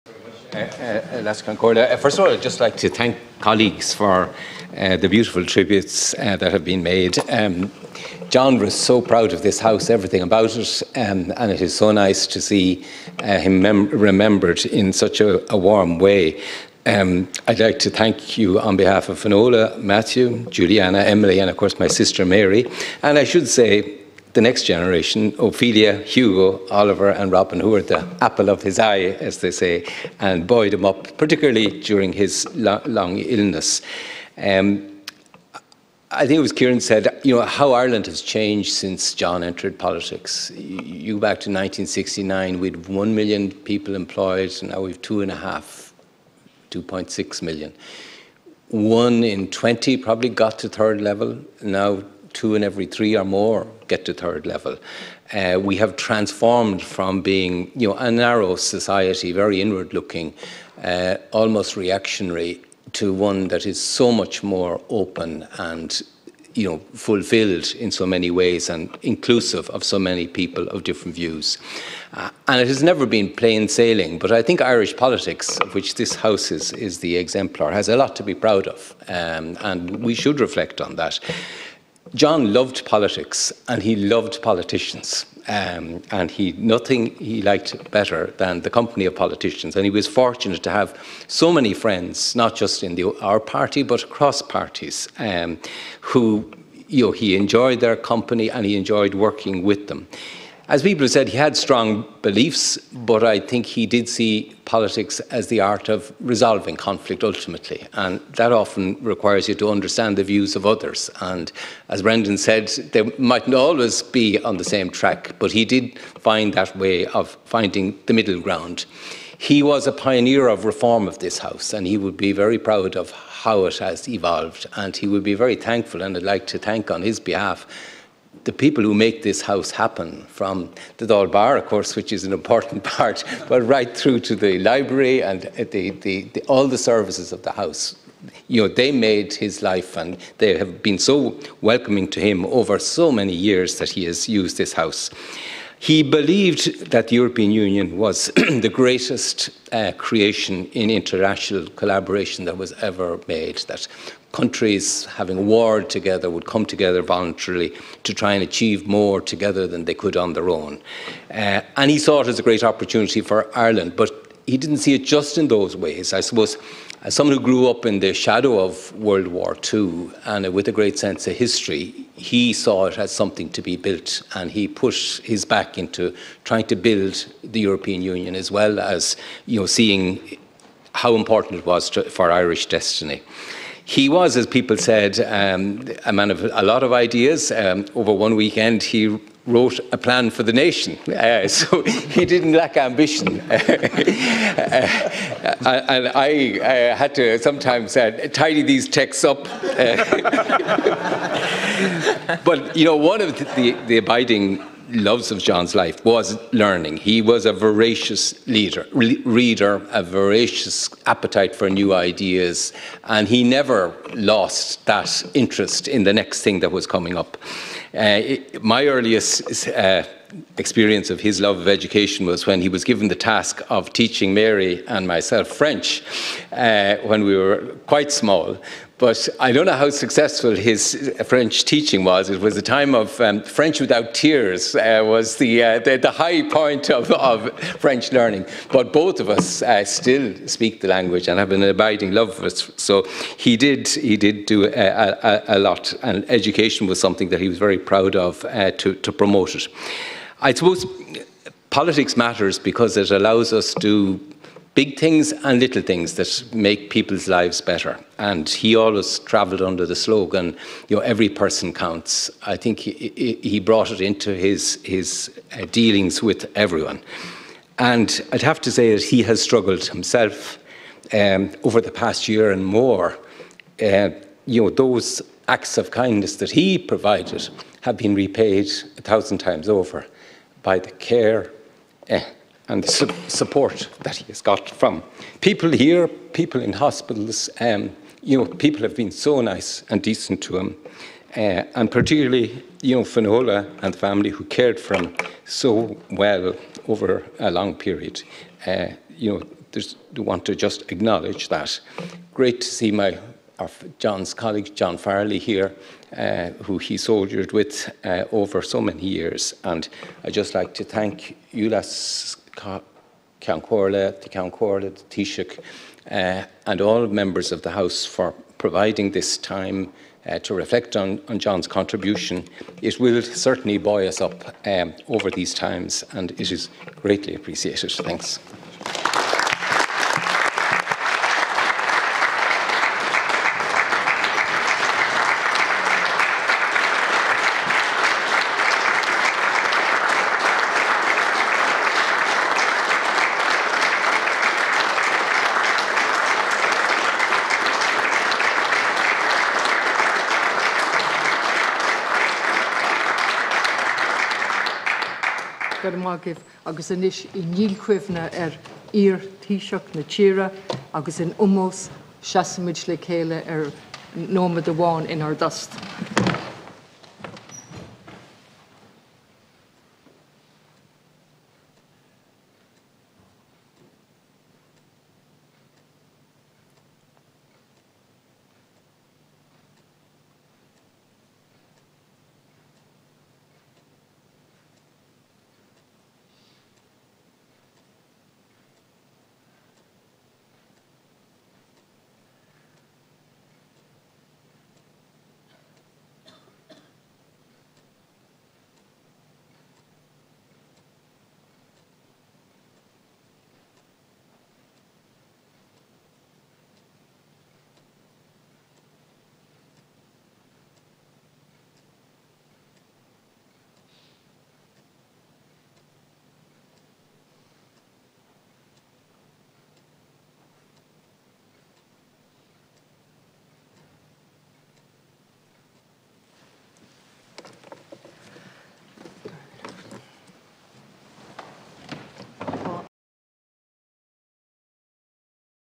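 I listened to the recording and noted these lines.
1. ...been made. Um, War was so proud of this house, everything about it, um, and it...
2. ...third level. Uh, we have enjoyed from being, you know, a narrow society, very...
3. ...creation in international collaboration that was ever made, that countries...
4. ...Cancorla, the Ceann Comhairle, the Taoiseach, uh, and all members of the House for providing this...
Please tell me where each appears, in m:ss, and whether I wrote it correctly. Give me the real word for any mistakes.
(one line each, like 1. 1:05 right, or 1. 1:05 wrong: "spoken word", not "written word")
1. 0:06 wrong: "John", not "War"
2. 0:54 wrong: "transformed", not "enjoyed"
3. 2:29 right
4. 5:13 right.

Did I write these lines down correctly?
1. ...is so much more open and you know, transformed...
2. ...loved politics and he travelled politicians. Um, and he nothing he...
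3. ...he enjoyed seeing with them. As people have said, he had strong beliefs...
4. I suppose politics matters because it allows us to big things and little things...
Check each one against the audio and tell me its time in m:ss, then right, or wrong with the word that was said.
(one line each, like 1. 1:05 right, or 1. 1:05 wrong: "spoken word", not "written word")
1. 1:03 wrong: "fulfilled", not "transformed"
2. 1:22 wrong: "loved", not "travelled"
3. 1:38 wrong: "working", not "seeing"
4. 4:10 right.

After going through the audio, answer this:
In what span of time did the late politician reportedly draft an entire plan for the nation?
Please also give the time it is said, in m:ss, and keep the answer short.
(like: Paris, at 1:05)
One weekend, at 3:08.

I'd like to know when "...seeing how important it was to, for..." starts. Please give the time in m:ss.
2:59.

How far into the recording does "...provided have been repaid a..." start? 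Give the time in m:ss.
4:36.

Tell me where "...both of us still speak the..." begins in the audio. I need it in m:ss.
3:58.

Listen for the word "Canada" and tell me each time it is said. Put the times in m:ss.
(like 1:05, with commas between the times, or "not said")
not said.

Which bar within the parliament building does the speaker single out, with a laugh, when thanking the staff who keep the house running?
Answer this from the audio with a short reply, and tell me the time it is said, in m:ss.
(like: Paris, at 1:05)
Dáil Bar, at 2:11.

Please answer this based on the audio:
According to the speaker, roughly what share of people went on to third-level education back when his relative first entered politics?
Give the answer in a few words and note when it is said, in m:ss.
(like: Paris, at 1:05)
One in 20, at 0:48.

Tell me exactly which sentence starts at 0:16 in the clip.
Um, I'd like to thank you on behalf of Finola, Matthew, Juliana, Emily, and of course my sister Mary.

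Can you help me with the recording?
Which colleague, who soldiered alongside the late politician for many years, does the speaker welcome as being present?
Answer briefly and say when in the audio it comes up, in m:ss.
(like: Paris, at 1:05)
John Farrelly, at 5:04.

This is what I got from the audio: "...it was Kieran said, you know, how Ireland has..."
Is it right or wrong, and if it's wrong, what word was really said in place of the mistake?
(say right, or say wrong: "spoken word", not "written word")
right.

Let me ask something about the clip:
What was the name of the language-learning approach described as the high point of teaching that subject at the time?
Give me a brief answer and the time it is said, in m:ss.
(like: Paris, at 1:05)
French without tears, at 3:53.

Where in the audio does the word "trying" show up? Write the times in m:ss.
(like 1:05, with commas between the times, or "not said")
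2:56.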